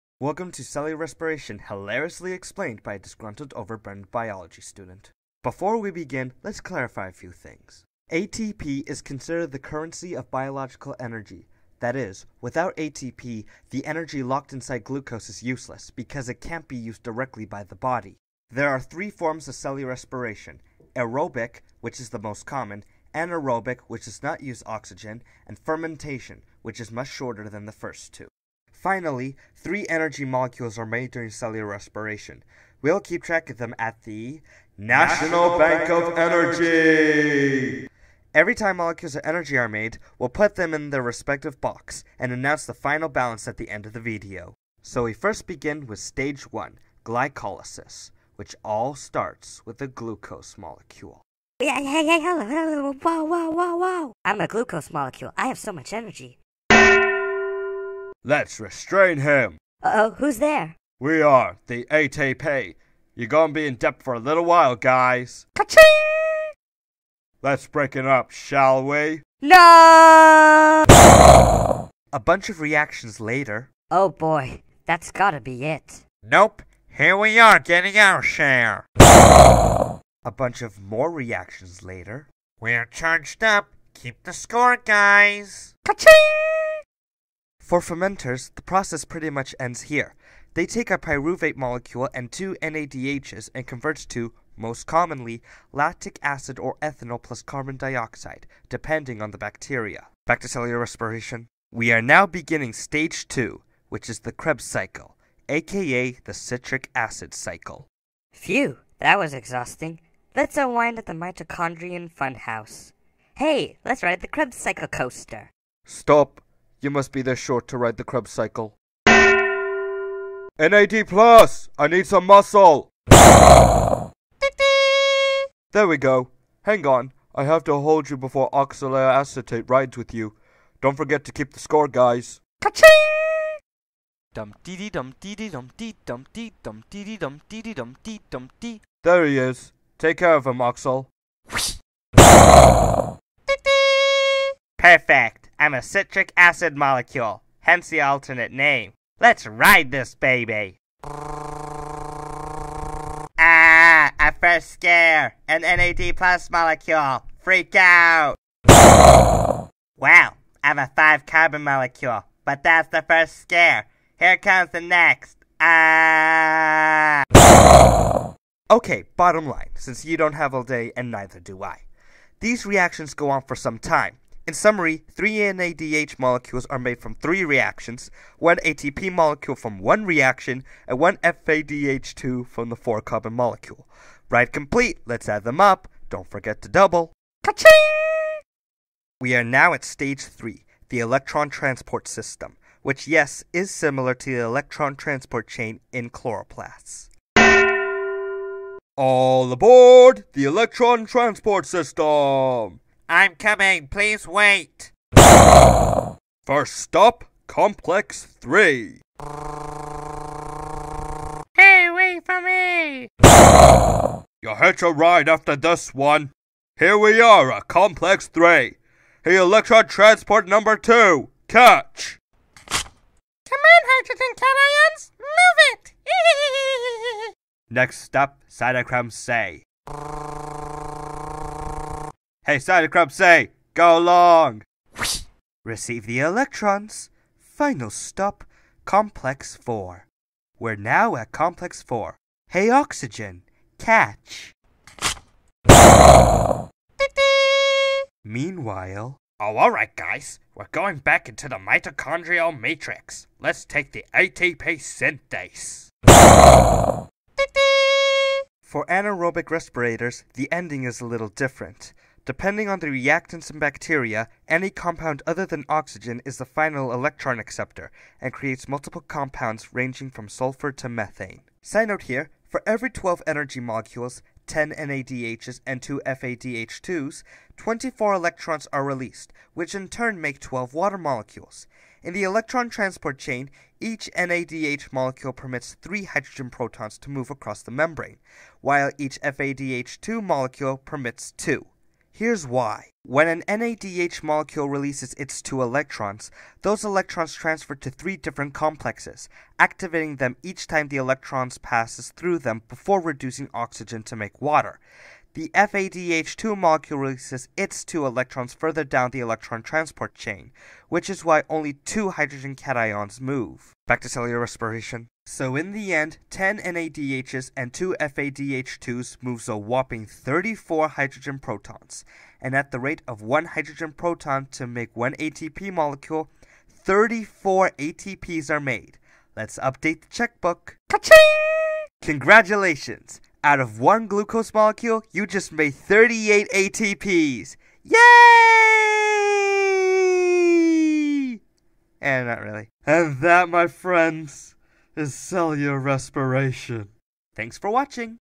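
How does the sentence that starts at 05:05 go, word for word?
The FADH2 molecule releases its two electrons further down the electron transport chain, which is why only two hydrogen cations move.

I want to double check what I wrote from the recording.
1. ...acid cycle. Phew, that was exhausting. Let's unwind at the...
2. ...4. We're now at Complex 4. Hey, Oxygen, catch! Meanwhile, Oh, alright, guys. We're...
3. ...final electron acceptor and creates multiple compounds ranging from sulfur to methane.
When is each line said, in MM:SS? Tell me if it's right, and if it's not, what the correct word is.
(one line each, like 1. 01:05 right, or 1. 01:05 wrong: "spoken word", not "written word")
1. 01:46 right
2. 03:59 right
3. 04:26 right.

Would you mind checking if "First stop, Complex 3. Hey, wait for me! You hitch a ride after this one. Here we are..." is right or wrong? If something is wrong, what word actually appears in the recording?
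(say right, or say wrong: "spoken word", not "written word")
right.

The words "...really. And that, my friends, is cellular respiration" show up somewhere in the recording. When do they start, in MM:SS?
05:42.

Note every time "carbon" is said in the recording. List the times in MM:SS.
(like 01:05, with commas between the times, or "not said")
01:37, 02:41, 03:03.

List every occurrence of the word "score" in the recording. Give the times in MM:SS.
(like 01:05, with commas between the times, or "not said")
01:24, 02:11.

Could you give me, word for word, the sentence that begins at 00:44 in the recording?
So we first begin with stage 1, glycolysis, which all starts with a glucose molecule.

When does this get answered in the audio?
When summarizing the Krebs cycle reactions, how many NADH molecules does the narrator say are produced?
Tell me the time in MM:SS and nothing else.
02:55.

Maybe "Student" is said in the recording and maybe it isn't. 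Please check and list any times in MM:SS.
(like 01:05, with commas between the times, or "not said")
00:04.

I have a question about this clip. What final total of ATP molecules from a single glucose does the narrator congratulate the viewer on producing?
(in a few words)
38.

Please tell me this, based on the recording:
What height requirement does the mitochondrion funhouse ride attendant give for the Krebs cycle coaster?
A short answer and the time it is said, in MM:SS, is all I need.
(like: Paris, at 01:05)
this short, at 01:57.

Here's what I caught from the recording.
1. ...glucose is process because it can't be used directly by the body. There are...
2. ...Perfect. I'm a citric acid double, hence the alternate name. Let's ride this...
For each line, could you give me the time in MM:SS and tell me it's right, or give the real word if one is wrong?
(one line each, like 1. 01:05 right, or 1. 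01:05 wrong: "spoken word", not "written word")
1. 00:14 wrong: "useless", not "process"
2. 02:24 wrong: "molecule", not "double".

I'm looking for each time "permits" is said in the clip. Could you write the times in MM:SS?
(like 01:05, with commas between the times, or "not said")
04:45, 04:50.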